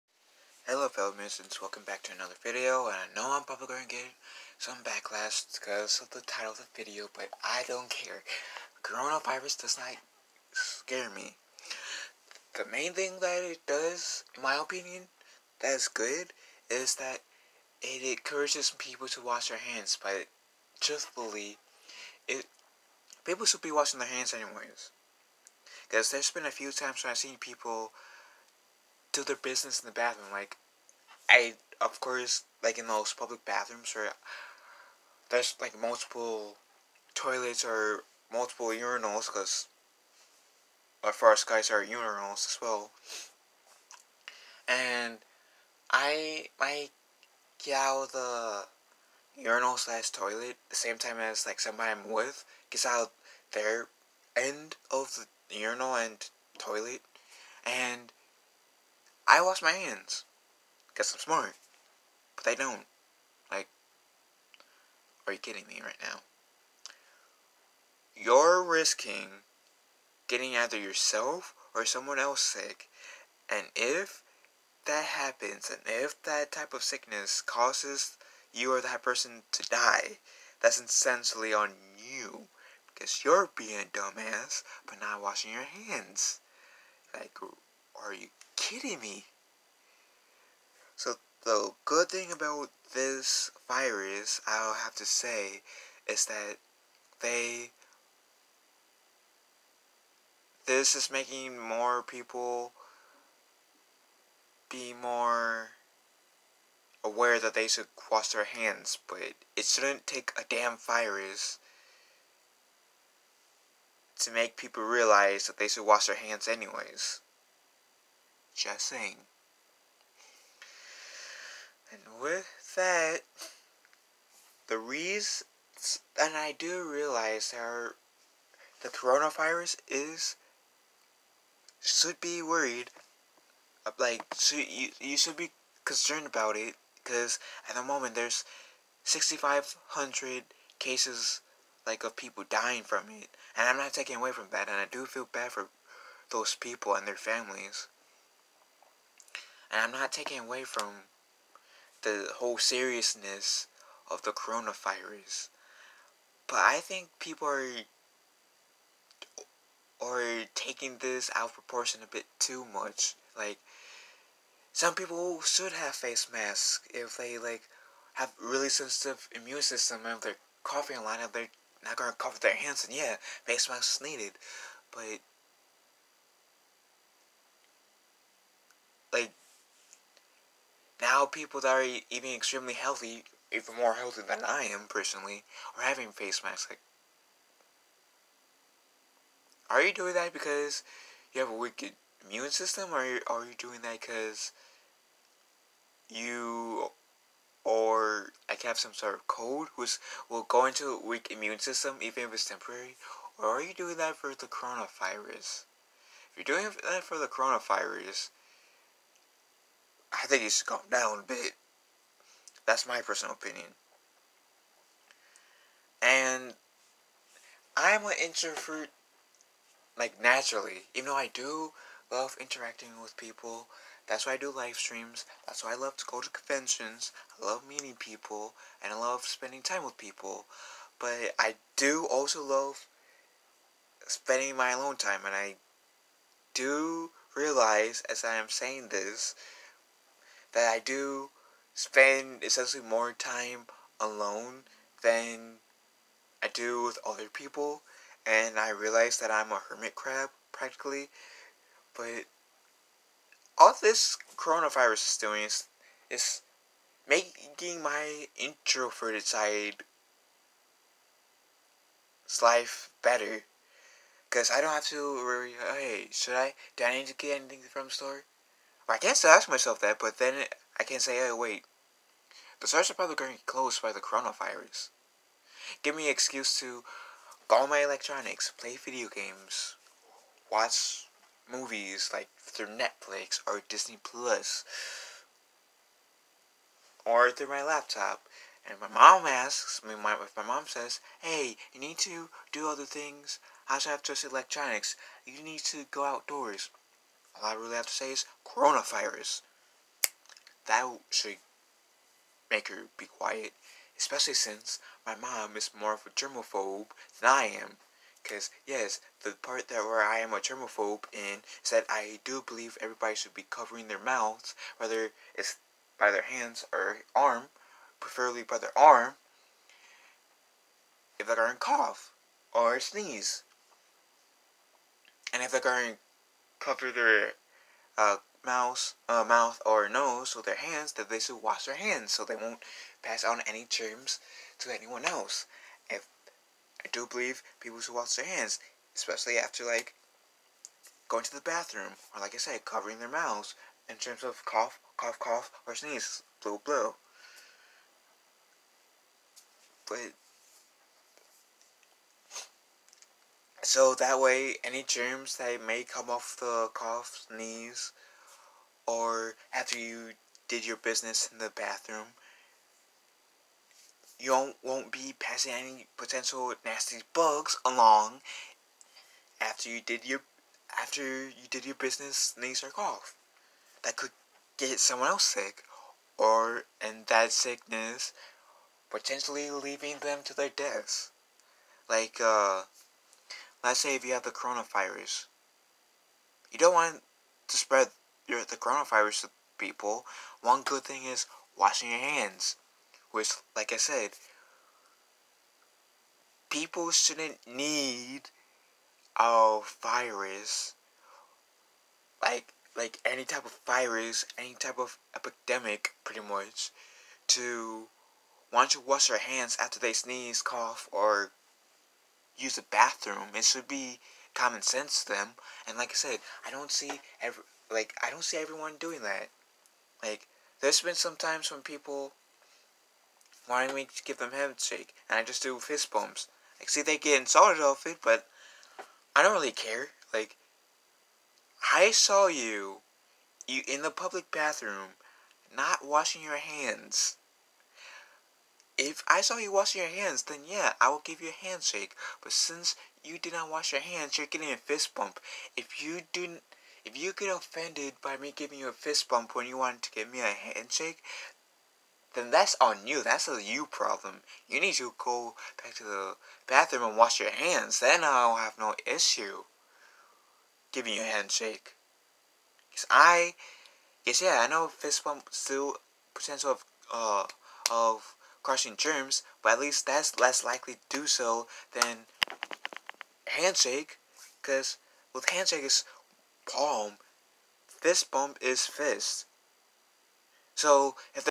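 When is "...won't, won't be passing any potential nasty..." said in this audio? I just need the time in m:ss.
6:04.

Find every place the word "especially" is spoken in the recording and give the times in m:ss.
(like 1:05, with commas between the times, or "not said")
5:03, 5:38.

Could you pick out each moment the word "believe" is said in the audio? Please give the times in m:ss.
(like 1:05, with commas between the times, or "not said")
5:12, 5:37.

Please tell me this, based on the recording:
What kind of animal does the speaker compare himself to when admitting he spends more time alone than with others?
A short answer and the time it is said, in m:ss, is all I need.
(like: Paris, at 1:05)
Hermit crab, at 4:09.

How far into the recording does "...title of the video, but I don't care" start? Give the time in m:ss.
0:06.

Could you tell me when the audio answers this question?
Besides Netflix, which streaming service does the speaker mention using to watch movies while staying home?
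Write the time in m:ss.
4:43.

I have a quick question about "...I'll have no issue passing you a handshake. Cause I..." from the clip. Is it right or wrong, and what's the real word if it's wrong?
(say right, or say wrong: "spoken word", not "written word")
wrong: "giving", not "passing".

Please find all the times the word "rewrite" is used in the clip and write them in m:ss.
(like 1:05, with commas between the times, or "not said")
not said.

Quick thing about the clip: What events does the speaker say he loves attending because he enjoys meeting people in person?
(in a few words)
Conventions.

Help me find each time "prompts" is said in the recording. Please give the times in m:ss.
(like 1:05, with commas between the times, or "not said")
not said.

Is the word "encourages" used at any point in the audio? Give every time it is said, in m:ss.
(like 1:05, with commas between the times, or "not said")
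0:18.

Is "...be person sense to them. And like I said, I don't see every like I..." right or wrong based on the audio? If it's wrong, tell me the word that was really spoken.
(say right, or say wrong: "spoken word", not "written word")
wrong: "common", not "person".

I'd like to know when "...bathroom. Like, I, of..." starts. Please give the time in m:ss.
0:29.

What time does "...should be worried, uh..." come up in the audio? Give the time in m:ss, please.
2:11.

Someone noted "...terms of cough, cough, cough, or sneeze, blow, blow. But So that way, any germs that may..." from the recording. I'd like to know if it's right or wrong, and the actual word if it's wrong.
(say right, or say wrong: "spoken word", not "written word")
right.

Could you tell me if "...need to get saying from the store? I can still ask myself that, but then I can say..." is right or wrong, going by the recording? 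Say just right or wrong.
wrong.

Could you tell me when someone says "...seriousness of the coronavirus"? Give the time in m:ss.
2:32.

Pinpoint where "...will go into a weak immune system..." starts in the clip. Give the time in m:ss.
3:20.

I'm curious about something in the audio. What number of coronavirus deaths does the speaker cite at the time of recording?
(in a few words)
6,500.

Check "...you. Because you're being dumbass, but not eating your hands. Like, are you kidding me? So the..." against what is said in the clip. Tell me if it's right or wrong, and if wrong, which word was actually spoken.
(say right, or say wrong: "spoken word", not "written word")
wrong: "washing", not "eating".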